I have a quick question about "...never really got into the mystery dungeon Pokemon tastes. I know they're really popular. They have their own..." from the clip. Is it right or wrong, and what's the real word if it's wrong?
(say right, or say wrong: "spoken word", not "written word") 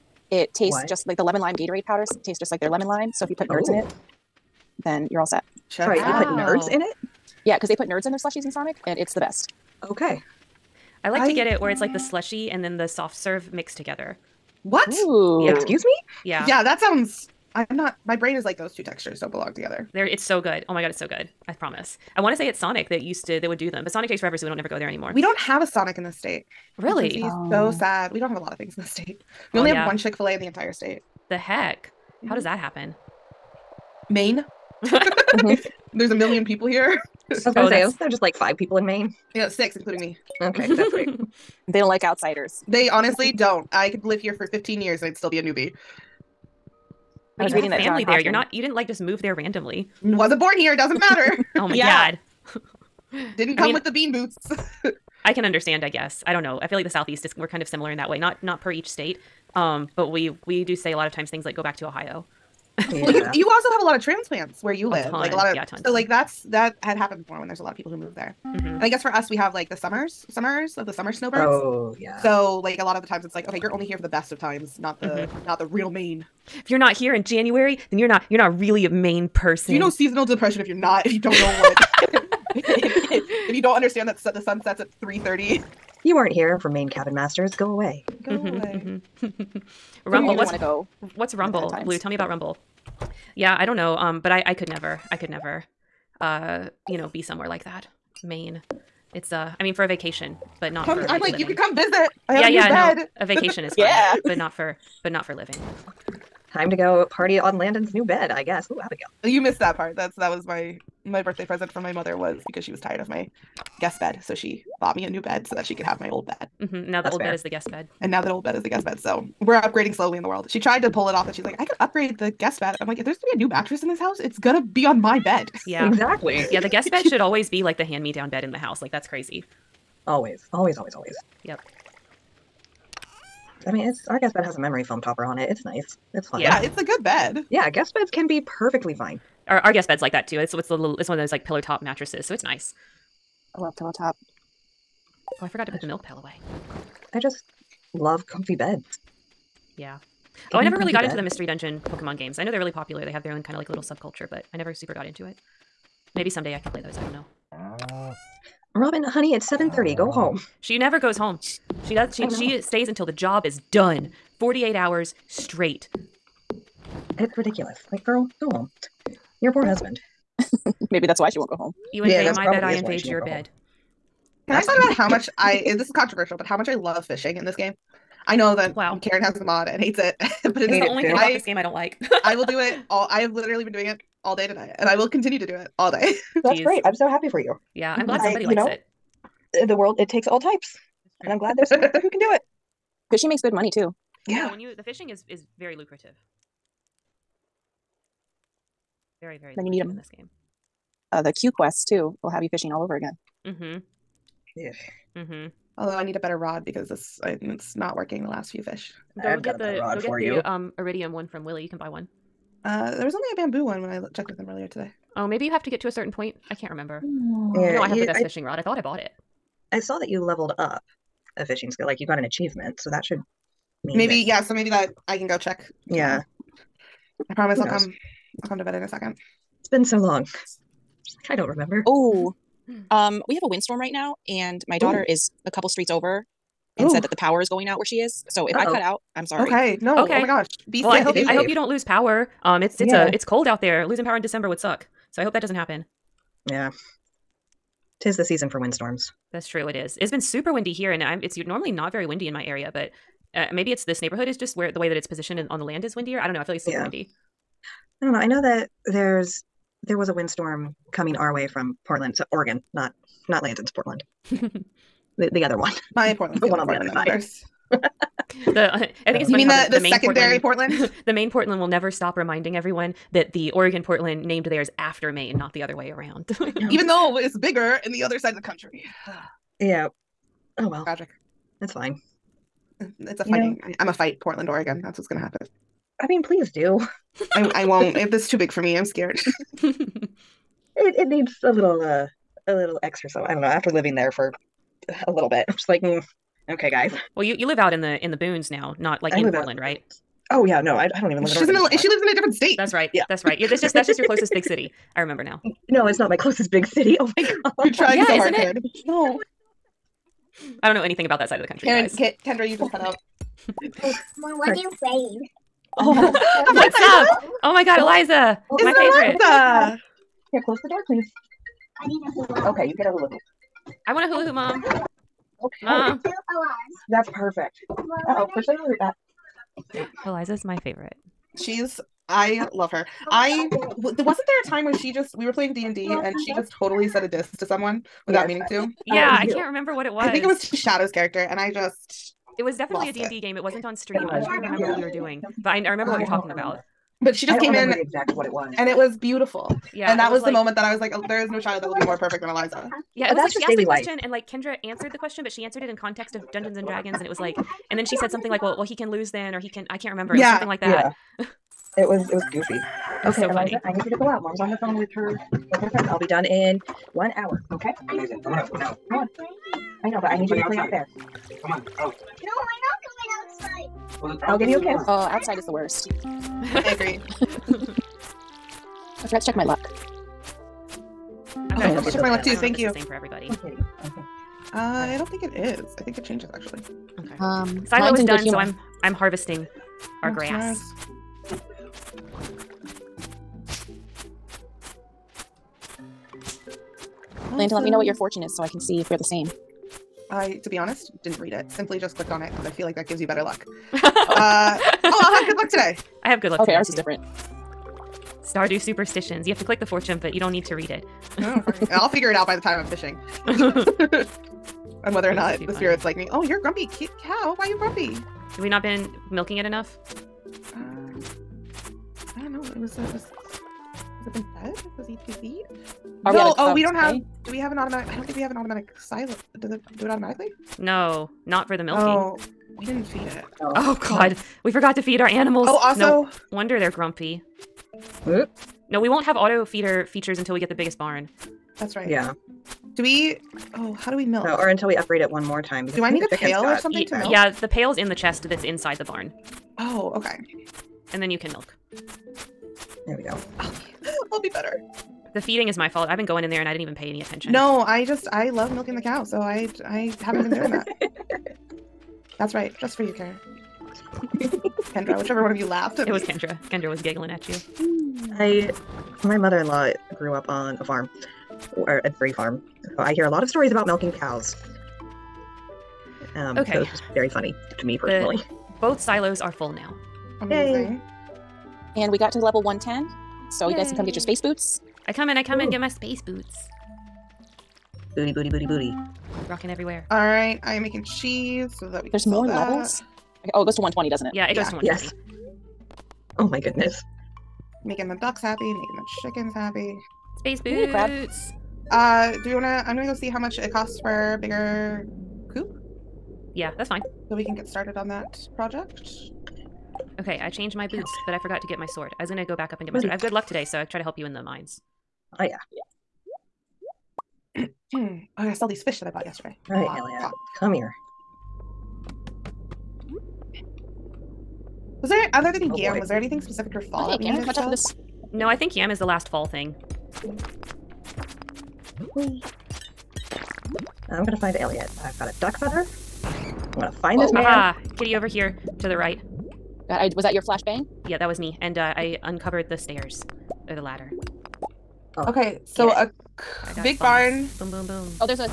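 wrong: "games", not "tastes".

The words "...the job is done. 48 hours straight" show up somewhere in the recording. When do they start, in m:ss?
2:43.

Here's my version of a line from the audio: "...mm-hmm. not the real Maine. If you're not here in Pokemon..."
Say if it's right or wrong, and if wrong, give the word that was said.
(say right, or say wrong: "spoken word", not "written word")
wrong: "January", not "Pokemon".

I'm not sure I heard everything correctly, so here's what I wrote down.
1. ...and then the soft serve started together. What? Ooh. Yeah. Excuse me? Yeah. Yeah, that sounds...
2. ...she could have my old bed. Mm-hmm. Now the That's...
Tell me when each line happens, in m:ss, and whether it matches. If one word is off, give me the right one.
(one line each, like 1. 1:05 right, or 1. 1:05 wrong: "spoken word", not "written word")
1. 0:12 wrong: "mixed", not "started"
2. 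1:55 right.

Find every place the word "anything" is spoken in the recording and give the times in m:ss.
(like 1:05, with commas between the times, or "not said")
5:10, 8:45.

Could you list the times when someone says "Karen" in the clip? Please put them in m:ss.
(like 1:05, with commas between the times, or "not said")
2:59, 5:11.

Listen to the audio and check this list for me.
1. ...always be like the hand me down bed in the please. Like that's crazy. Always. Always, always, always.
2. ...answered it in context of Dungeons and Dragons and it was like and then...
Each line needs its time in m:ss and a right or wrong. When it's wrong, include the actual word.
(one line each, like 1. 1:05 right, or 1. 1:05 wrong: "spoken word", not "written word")
1. 2:07 wrong: "house", not "please"
2. 5:55 right.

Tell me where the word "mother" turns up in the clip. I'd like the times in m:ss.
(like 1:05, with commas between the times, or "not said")
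1:51, 7:49.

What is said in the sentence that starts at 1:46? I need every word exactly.
Time to go party on Landon's new bed, I guess.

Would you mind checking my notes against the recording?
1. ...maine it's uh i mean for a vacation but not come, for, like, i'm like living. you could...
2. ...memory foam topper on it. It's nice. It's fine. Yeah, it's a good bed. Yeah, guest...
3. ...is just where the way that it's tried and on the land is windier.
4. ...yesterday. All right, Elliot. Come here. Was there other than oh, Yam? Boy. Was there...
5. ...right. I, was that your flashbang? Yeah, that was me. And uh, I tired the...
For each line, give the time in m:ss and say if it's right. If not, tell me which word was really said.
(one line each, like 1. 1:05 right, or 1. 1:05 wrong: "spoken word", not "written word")
1. 1:38 right
2. 2:14 right
3. 4:14 wrong: "positioned", not "tried"
4. 8:39 right
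5. 8:58 wrong: "uncovered", not "tired".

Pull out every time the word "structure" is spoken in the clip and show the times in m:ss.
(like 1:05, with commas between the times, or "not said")
not said.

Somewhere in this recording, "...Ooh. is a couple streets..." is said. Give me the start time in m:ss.
3:55.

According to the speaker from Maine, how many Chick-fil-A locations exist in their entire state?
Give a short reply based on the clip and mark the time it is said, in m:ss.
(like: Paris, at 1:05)
1, at 0:29.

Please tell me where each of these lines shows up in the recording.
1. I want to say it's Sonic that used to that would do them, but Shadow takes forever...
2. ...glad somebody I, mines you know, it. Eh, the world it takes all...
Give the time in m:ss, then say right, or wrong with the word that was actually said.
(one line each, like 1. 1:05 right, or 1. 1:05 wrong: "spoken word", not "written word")
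1. 0:22 wrong: "Sonic", not "Shadow"
2. 3:08 wrong: "likes", not "mines".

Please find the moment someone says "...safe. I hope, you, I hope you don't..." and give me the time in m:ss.
4:00.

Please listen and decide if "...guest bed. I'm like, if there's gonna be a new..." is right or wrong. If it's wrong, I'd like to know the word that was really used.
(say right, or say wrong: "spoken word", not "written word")
right.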